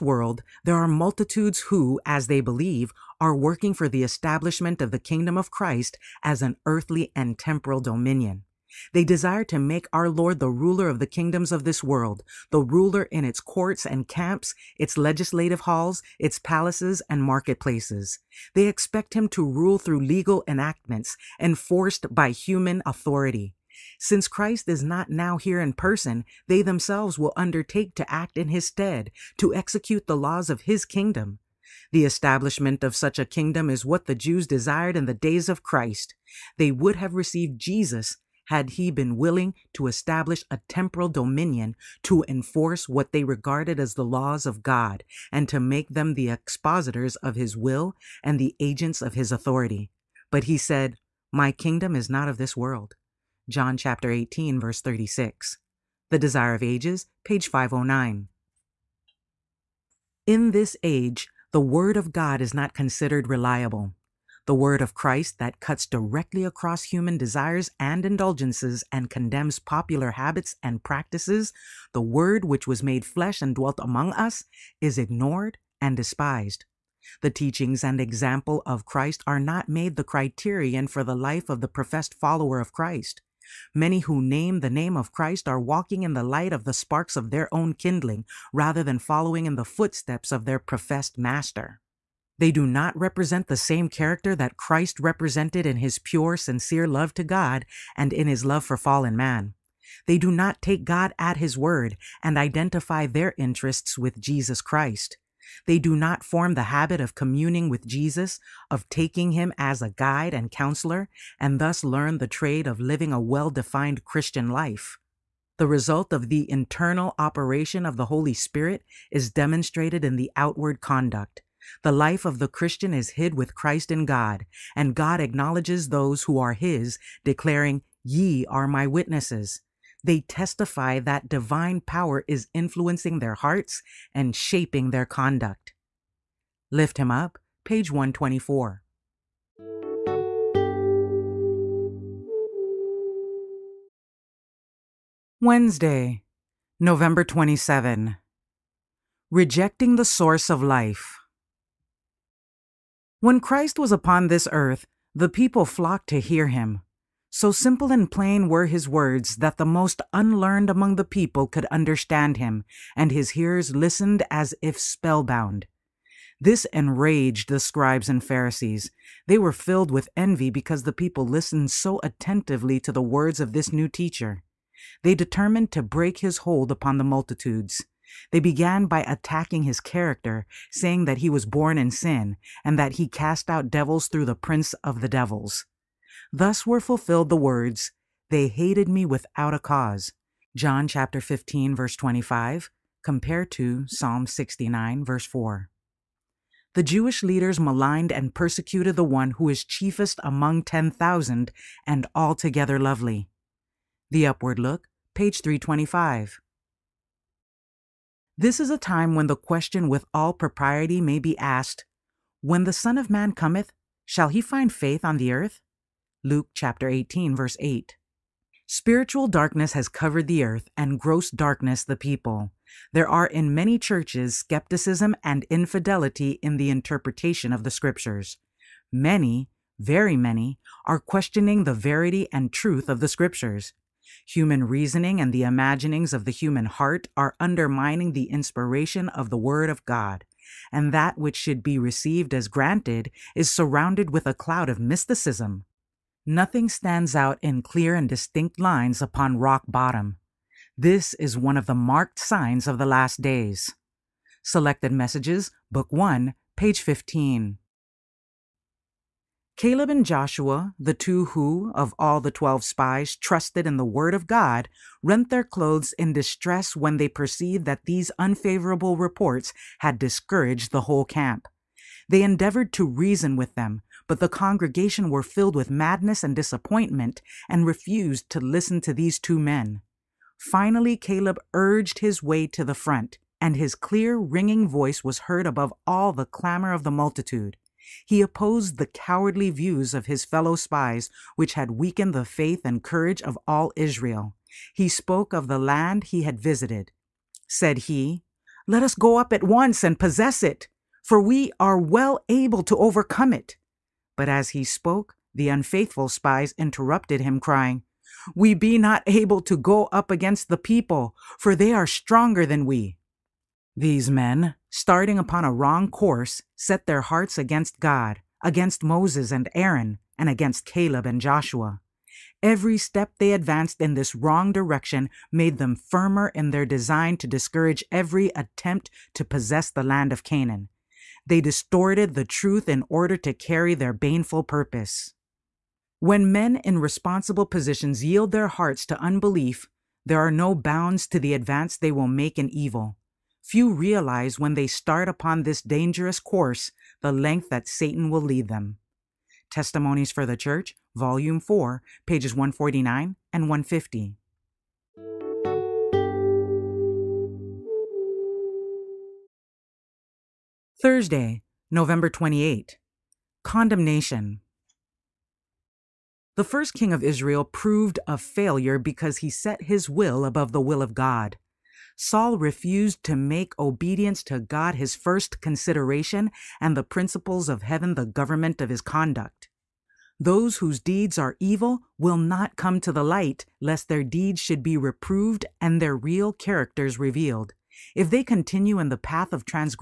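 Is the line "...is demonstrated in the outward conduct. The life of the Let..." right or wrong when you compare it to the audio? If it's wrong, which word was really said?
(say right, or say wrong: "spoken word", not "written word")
wrong: "Christian", not "Let".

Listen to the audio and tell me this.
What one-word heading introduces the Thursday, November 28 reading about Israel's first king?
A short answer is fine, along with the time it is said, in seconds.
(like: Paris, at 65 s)
Condemnation, at 363 s.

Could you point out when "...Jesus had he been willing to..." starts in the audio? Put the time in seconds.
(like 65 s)
37 s.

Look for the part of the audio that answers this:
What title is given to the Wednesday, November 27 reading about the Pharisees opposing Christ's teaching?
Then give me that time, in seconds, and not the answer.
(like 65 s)
149 s.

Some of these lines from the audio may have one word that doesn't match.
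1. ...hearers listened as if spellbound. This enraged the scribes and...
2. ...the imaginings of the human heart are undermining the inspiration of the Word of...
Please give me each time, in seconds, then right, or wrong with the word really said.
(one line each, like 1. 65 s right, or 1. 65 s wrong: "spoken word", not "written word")
1. 163 s right
2. 235 s right.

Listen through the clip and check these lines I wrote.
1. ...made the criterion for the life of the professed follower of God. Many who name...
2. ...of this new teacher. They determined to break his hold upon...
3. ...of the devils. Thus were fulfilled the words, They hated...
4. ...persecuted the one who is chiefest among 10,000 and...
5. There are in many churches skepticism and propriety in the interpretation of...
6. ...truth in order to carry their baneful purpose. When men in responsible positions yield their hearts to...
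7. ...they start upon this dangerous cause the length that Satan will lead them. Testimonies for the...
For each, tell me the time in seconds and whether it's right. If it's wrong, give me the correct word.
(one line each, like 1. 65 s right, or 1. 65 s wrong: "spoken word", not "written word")
1. 79 s wrong: "Christ", not "God"
2. 173 s right
3. 184 s right
4. 198 s right
5. 222 s wrong: "infidelity", not "propriety"
6. 332 s right
7. 344 s wrong: "course", not "cause".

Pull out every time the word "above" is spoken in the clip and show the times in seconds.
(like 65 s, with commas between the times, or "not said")
285 s, 370 s.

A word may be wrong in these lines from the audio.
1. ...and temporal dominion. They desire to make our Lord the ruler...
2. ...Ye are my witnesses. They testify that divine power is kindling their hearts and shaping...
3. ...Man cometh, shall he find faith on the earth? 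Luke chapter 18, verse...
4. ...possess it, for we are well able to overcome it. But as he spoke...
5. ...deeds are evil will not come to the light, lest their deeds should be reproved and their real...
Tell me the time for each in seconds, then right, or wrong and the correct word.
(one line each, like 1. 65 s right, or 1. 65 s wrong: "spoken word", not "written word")
1. 7 s right
2. 128 s wrong: "influencing", not "kindling"
3. 213 s right
4. 299 s right
5. 380 s right.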